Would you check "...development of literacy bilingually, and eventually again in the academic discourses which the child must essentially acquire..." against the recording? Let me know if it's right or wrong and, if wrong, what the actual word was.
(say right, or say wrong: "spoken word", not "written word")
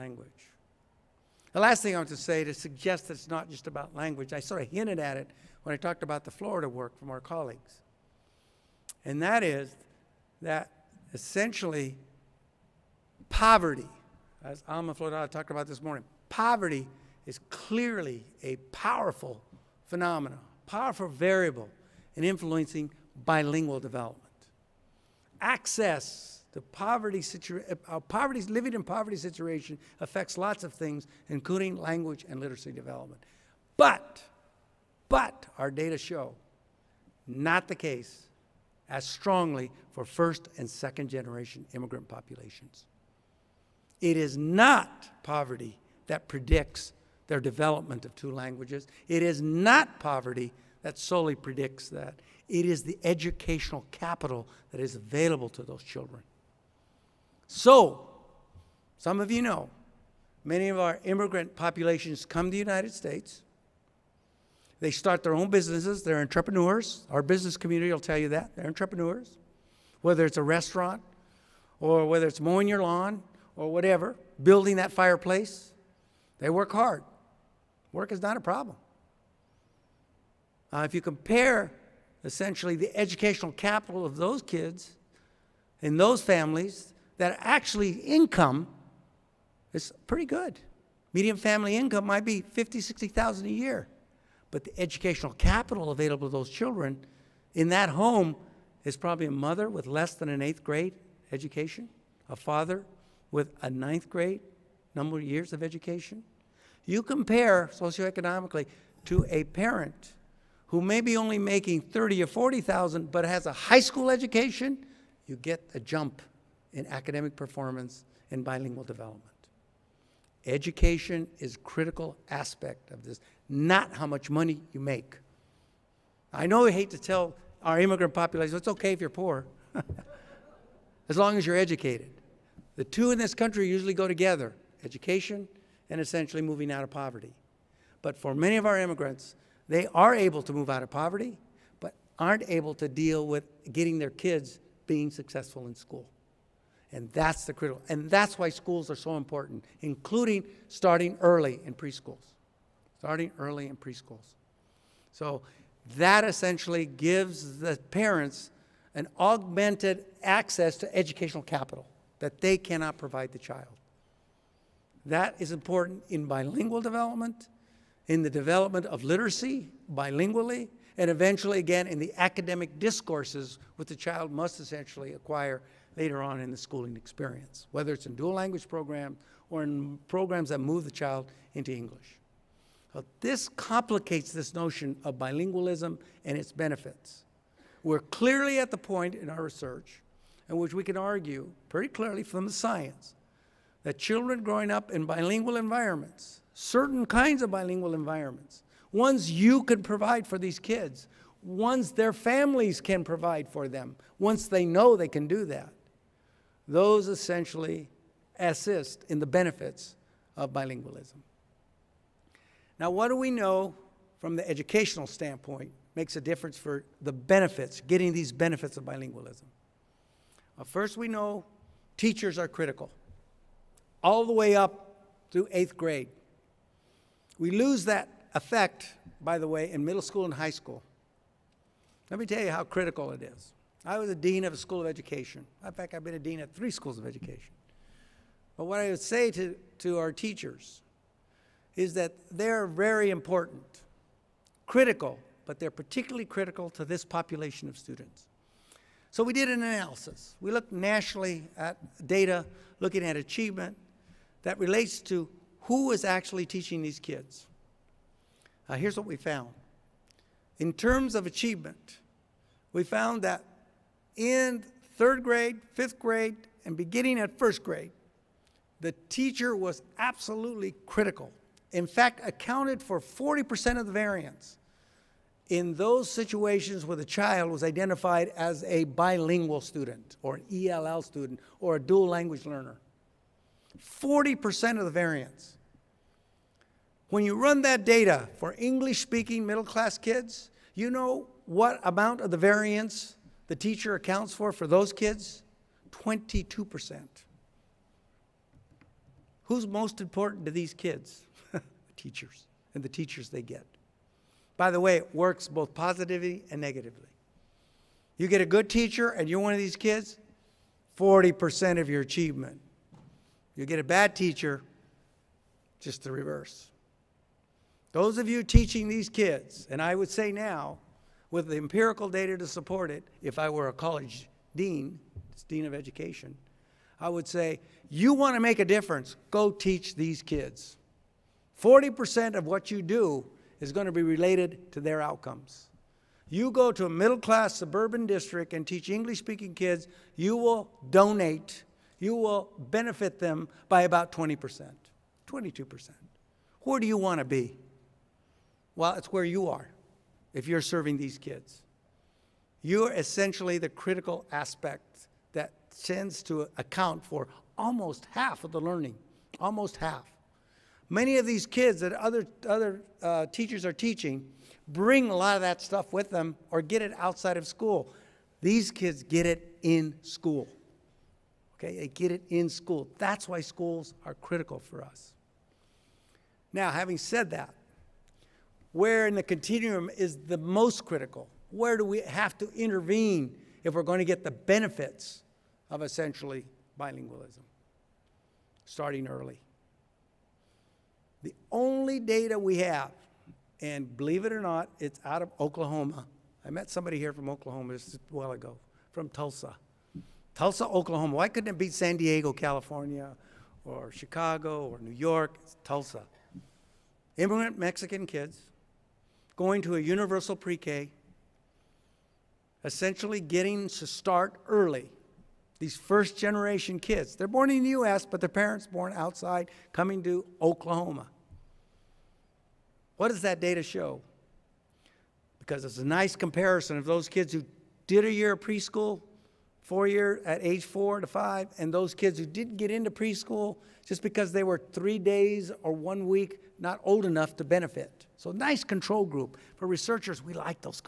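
right.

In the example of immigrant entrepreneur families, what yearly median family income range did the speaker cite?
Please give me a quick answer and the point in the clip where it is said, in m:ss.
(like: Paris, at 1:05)
50,000-60,000, at 1:32.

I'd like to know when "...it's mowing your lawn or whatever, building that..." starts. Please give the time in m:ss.
1:12.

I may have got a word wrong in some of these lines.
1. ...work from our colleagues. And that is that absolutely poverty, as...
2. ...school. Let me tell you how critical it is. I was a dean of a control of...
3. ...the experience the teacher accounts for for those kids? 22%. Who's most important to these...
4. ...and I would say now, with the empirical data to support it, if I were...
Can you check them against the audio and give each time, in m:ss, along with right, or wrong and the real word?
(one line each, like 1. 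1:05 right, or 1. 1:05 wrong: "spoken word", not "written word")
1. 0:06 wrong: "essentially", not "absolutely"
2. 3:50 wrong: "school", not "control"
3. 4:52 wrong: "variance", not "experience"
4. 5:19 right.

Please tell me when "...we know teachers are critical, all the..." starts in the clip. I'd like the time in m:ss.
3:40.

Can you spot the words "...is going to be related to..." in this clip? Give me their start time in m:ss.
5:33.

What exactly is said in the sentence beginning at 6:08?
These kids get it in school.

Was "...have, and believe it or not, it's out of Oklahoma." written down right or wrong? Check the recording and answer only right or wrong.
right.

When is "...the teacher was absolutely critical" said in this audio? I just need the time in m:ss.
4:28.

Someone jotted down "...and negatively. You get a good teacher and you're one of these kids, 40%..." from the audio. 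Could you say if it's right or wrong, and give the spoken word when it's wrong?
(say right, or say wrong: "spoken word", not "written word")
right.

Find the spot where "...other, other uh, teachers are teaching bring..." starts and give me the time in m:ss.
6:01.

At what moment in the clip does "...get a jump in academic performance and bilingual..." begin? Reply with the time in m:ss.
1:55.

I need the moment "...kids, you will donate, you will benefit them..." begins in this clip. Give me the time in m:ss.
5:39.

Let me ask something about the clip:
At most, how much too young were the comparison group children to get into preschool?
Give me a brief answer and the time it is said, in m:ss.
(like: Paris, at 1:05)
one week, at 7:15.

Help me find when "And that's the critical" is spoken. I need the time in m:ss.
2:26.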